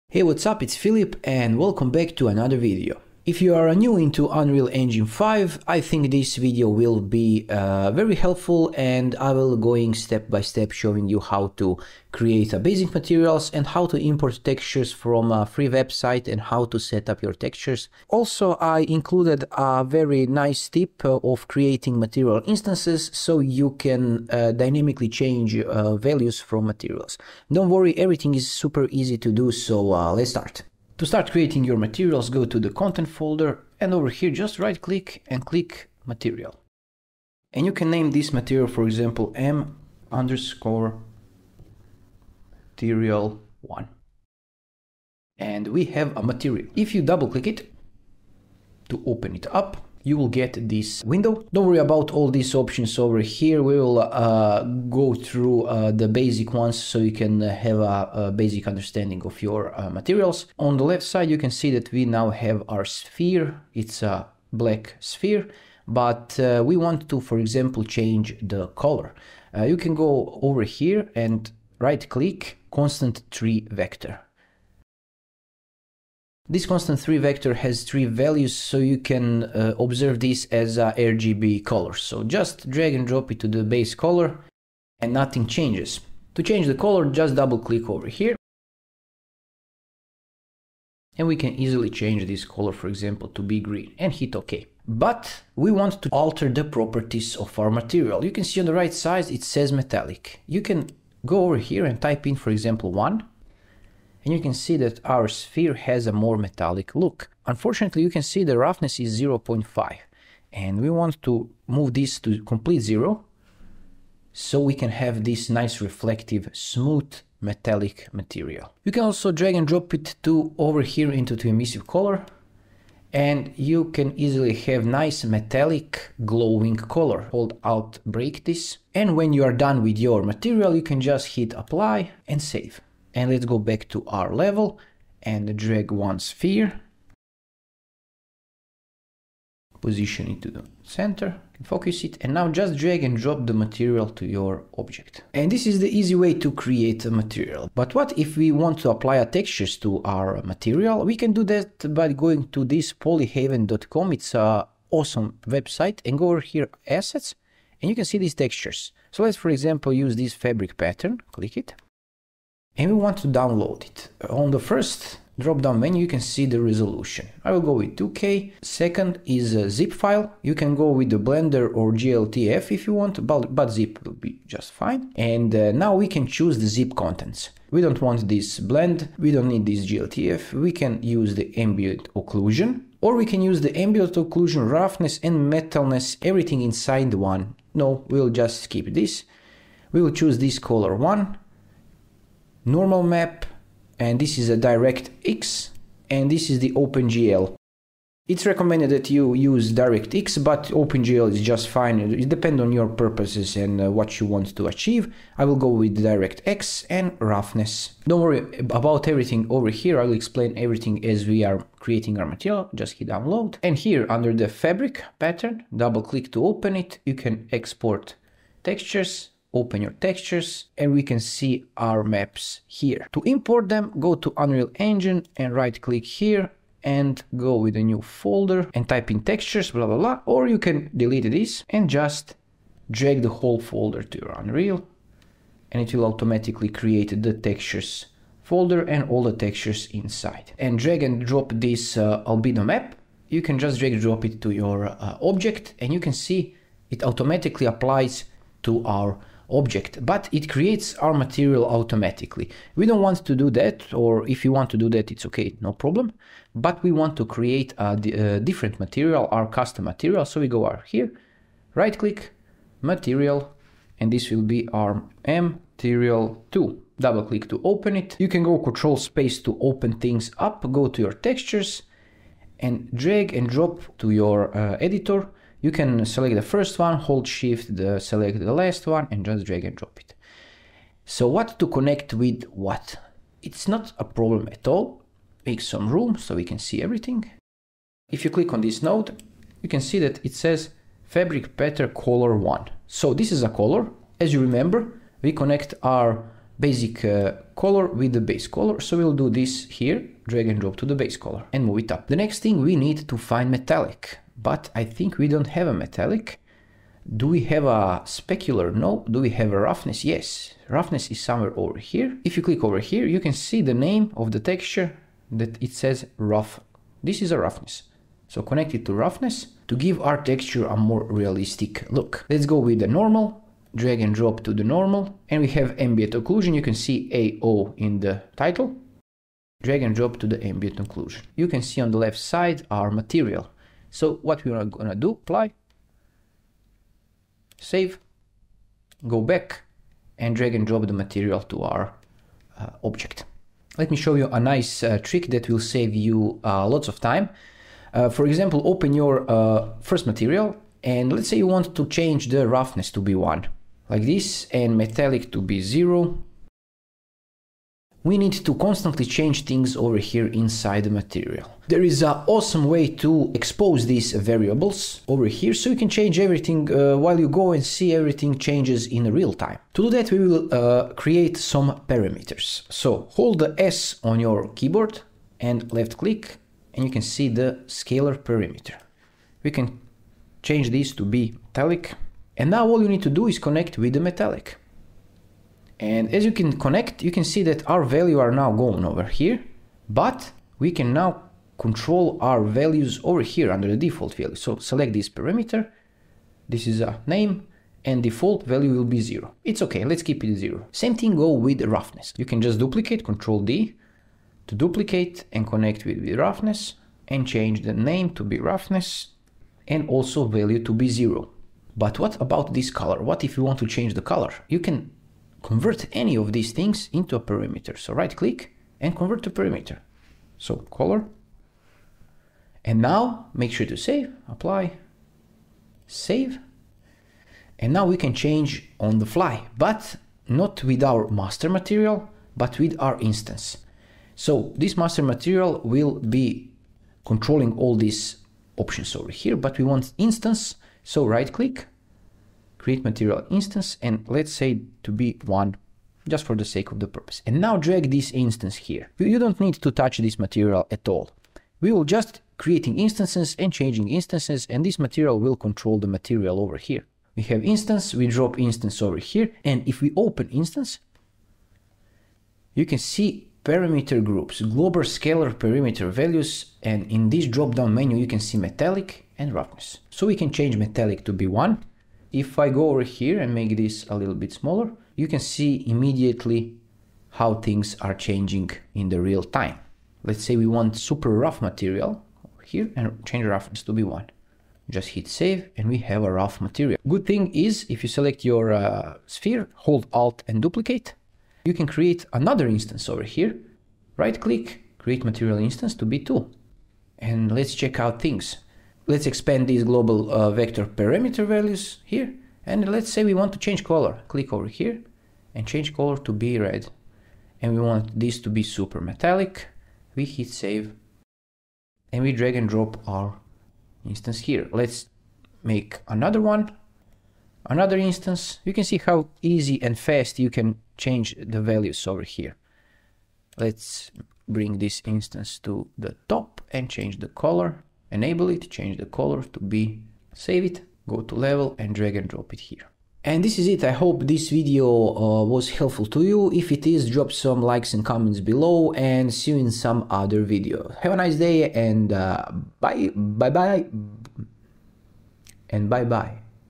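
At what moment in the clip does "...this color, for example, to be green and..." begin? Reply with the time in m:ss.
1:32.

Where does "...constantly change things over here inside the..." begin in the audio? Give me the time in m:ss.
5:58.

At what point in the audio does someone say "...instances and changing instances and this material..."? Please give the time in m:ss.
7:32.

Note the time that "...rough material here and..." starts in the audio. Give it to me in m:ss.
8:01.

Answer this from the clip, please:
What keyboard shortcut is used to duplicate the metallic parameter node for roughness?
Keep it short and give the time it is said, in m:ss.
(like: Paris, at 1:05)
Control D, at 6:43.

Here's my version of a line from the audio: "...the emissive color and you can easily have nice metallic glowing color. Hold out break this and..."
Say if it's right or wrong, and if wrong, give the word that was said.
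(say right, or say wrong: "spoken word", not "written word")
right.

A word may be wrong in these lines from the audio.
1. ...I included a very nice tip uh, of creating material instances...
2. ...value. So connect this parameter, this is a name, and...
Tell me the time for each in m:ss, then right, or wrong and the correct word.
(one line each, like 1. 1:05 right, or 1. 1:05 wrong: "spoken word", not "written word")
1. 0:18 right
2. 6:34 wrong: "select", not "connect".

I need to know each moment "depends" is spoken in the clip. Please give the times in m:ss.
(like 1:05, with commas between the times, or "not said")
3:22.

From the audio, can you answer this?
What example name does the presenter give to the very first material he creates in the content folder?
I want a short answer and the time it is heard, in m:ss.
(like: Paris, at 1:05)
M_material1, at 0:39.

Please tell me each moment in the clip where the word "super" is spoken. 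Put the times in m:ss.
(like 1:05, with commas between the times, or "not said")
0:28, 8:00, 8:28.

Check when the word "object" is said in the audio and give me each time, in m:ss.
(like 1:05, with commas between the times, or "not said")
2:24, 4:05, 4:09, 5:42.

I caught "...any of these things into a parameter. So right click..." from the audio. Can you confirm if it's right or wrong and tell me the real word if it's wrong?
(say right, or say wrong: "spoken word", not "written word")
right.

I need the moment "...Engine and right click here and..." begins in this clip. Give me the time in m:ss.
3:44.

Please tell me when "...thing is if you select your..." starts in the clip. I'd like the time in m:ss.
8:07.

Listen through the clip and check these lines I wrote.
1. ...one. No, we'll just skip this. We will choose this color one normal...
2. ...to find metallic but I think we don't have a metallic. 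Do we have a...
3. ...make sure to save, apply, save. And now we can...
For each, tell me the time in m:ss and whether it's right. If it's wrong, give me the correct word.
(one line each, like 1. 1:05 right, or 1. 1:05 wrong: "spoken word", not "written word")
1. 3:07 right
2. 5:03 right
3. 7:03 right.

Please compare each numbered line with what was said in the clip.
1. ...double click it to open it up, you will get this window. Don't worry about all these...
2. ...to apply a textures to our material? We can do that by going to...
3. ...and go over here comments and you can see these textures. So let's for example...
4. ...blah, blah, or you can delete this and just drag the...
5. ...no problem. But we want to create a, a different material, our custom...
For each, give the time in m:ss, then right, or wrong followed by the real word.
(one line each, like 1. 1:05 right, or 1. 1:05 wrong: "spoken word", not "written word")
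1. 0:47 right
2. 2:28 right
3. 2:36 wrong: "assets", not "comments"
4. 3:49 right
5. 4:15 right.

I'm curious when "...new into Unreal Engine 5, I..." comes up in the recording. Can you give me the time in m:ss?
0:03.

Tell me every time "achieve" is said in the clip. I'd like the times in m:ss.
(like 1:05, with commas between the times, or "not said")
3:24.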